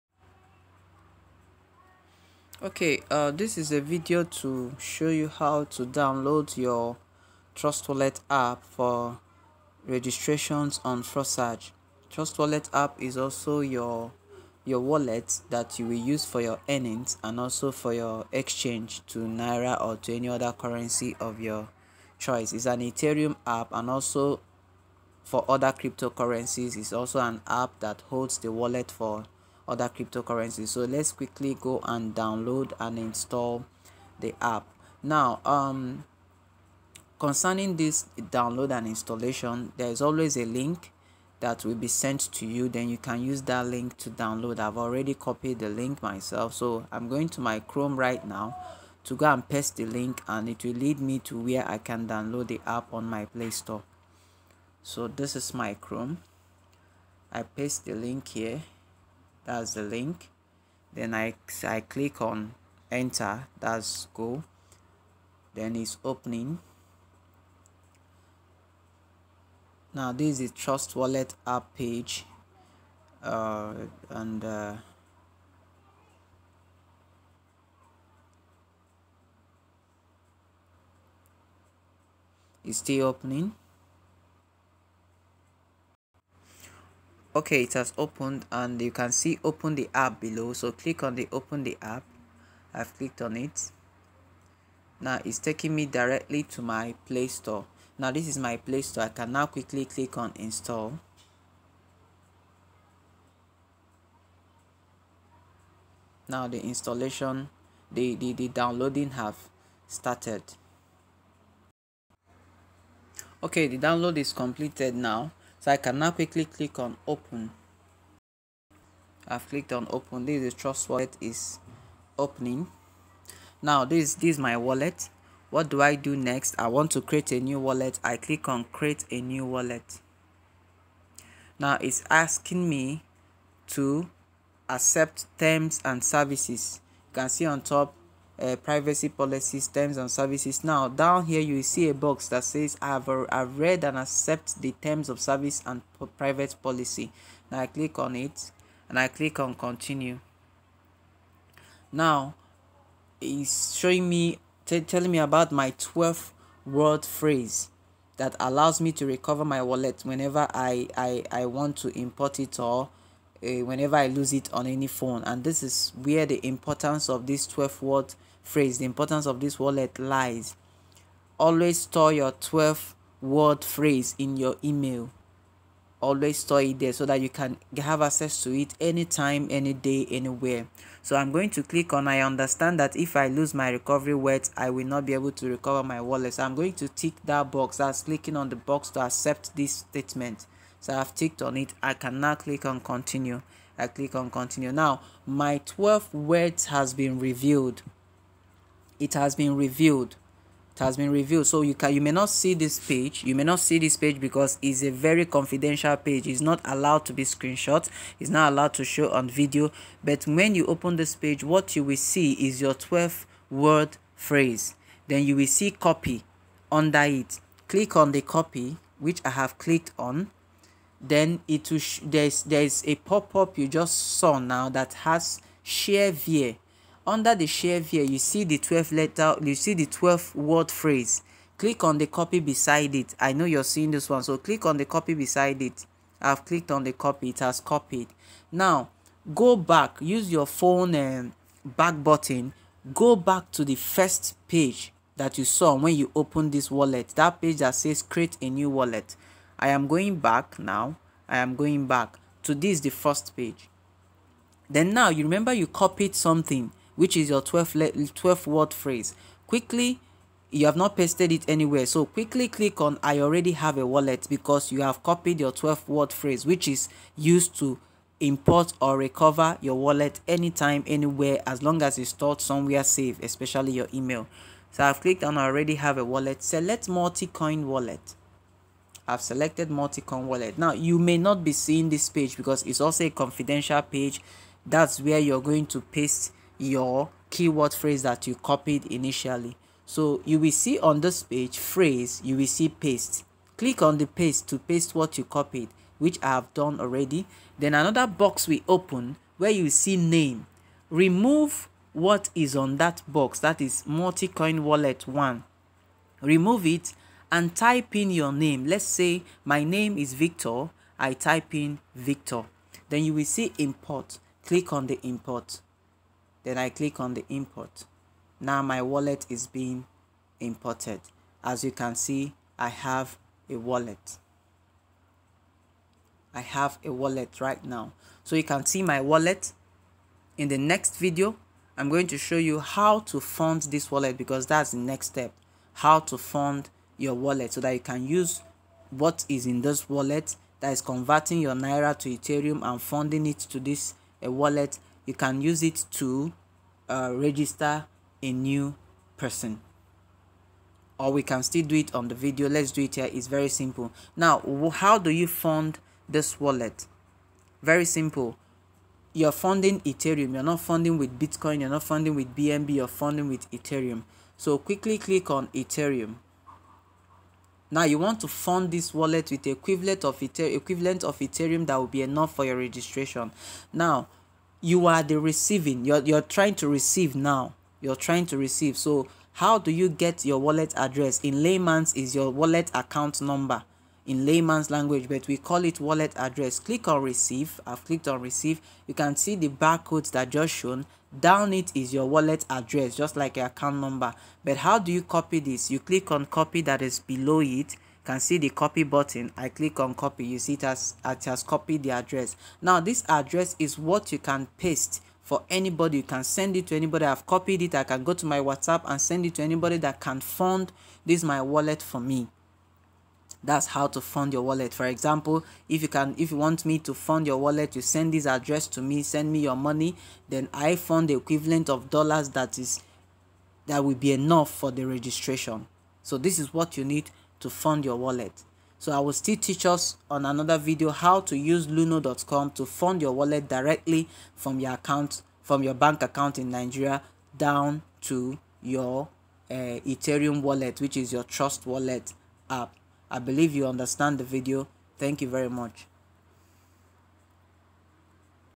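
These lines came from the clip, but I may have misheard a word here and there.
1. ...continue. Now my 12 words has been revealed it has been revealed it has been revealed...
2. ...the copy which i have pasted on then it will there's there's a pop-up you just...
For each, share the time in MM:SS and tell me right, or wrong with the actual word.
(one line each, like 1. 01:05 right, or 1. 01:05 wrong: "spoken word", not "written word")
1. 03:14 right
2. 03:38 wrong: "clicked", not "pasted".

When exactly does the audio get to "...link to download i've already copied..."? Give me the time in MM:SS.
00:43.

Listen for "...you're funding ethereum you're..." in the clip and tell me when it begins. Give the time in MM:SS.
05:59.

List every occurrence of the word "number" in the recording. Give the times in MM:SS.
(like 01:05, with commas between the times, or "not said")
06:23, 06:33.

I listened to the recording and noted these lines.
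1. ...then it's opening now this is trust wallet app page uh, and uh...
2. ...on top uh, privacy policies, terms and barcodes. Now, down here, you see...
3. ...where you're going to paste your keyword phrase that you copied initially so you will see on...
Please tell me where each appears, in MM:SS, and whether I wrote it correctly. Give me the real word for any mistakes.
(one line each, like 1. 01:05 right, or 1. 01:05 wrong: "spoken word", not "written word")
1. 01:05 right
2. 02:17 wrong: "services", not "barcodes"
3. 04:45 right.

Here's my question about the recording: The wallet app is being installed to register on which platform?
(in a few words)
Forsage.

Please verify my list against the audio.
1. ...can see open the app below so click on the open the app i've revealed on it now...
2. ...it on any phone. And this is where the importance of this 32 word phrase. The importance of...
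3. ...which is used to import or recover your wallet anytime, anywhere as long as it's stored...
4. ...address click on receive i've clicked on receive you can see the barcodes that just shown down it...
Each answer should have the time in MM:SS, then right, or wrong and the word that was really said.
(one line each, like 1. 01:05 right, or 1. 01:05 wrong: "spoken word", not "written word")
1. 01:28 wrong: "clicked", not "revealed"
2. 02:44 wrong: "12", not "32"
3. 04:26 right
4. 06:26 right.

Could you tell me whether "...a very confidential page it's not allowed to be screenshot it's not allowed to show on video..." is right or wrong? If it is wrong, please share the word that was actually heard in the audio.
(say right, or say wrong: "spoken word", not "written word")
right.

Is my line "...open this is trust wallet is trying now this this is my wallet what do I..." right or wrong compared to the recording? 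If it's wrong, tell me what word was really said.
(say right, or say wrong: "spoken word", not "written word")
wrong: "opening", not "trying".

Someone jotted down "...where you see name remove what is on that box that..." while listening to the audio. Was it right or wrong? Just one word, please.
right.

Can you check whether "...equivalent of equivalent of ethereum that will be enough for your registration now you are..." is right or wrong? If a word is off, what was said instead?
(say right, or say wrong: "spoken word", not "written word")
right.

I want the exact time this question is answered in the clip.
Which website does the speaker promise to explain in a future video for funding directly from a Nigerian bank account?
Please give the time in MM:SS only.
07:11.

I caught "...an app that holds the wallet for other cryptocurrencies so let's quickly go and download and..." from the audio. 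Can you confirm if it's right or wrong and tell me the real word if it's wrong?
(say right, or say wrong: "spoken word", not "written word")
right.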